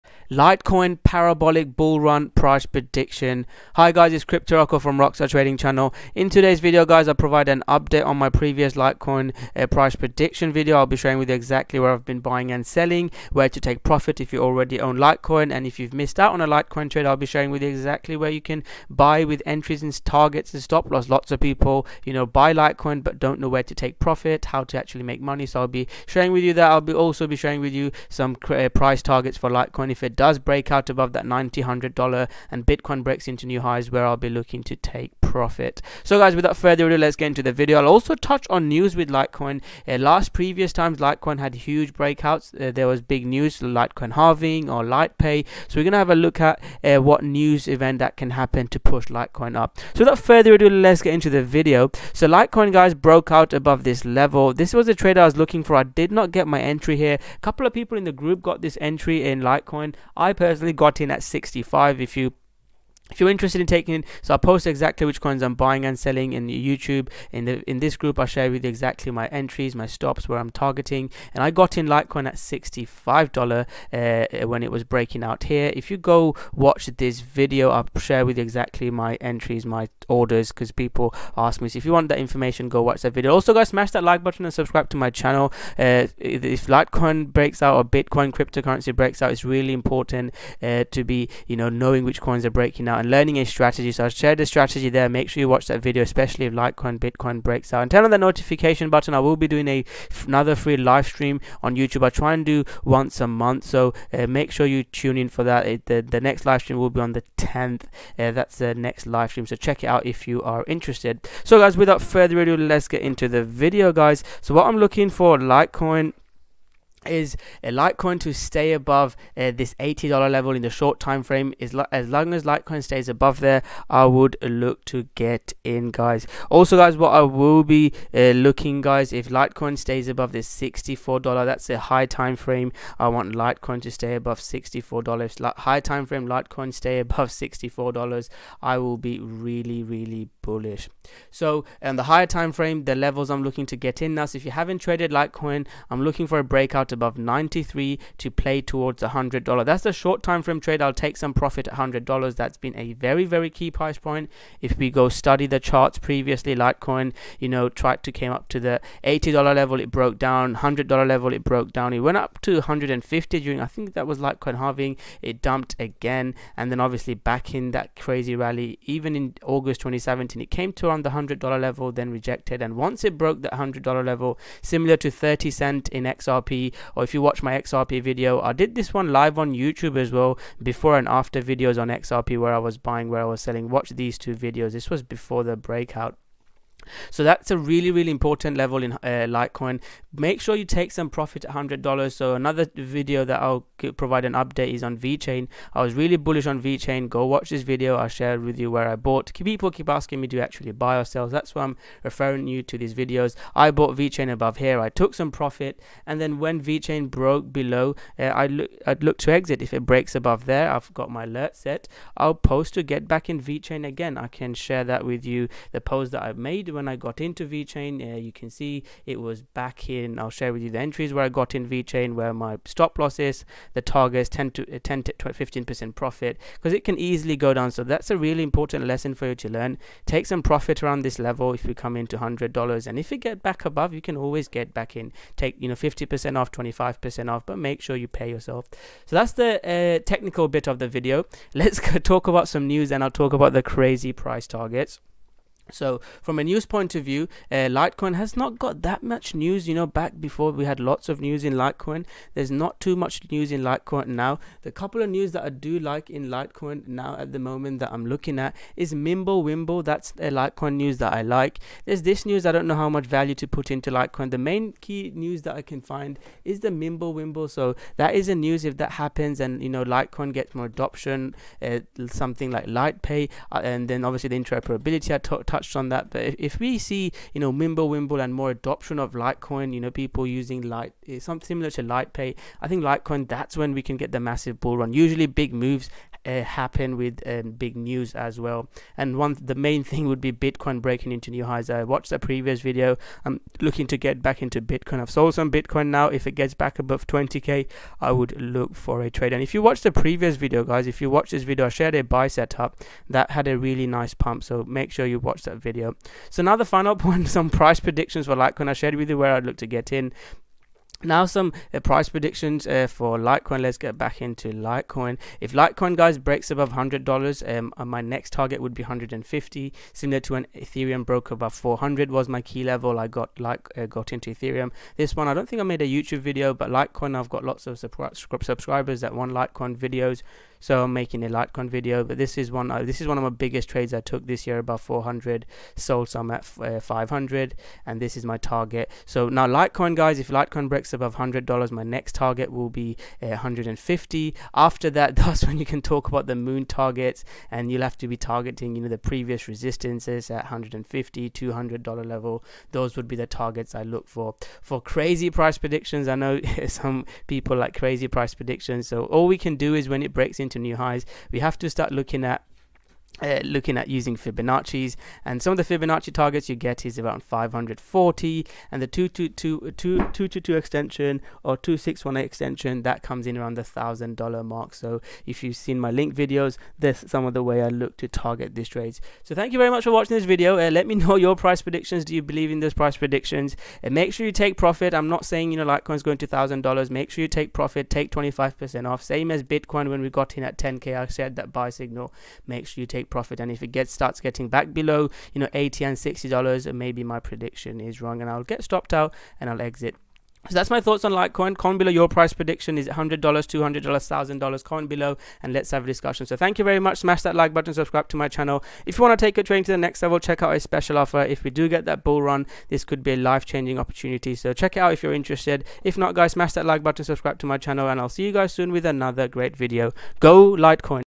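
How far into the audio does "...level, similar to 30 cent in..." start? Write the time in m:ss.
2:54.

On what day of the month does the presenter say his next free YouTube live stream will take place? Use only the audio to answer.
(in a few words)
the 10th.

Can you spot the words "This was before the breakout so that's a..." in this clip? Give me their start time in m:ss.
3:04.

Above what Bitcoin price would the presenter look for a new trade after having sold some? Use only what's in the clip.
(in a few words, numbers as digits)
20k.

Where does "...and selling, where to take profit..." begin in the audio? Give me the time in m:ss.
0:12.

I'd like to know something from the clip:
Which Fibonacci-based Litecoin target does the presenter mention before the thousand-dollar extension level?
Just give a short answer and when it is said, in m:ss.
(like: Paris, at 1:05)
540, at 6:07.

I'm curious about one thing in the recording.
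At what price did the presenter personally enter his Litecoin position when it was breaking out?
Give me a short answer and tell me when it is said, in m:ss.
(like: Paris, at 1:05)
$65, at 1:11.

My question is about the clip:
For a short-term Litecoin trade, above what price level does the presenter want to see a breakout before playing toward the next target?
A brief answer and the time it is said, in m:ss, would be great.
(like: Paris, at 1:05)
93, at 2:26.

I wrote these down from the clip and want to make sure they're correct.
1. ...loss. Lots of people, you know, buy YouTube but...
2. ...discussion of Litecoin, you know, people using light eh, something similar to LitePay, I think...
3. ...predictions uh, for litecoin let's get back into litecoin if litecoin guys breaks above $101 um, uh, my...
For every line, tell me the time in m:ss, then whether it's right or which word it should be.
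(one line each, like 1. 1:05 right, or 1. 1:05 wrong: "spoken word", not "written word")
1. 0:20 wrong: "Litecoin", not "YouTube"
2. 4:38 wrong: "adoption", not "discussion"
3. 5:12 wrong: "100", not "101".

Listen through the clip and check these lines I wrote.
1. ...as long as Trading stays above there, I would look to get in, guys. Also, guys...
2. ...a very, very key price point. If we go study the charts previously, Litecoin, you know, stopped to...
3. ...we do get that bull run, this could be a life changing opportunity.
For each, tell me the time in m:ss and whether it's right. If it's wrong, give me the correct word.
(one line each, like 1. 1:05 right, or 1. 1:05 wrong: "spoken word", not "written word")
1. 2:01 wrong: "Litecoin", not "Trading"
2. 2:32 wrong: "tried", not "stopped"
3. 6:51 right.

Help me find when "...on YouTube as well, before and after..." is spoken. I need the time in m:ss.
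2:59.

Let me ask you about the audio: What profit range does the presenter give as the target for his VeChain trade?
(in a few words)
10 to 15%.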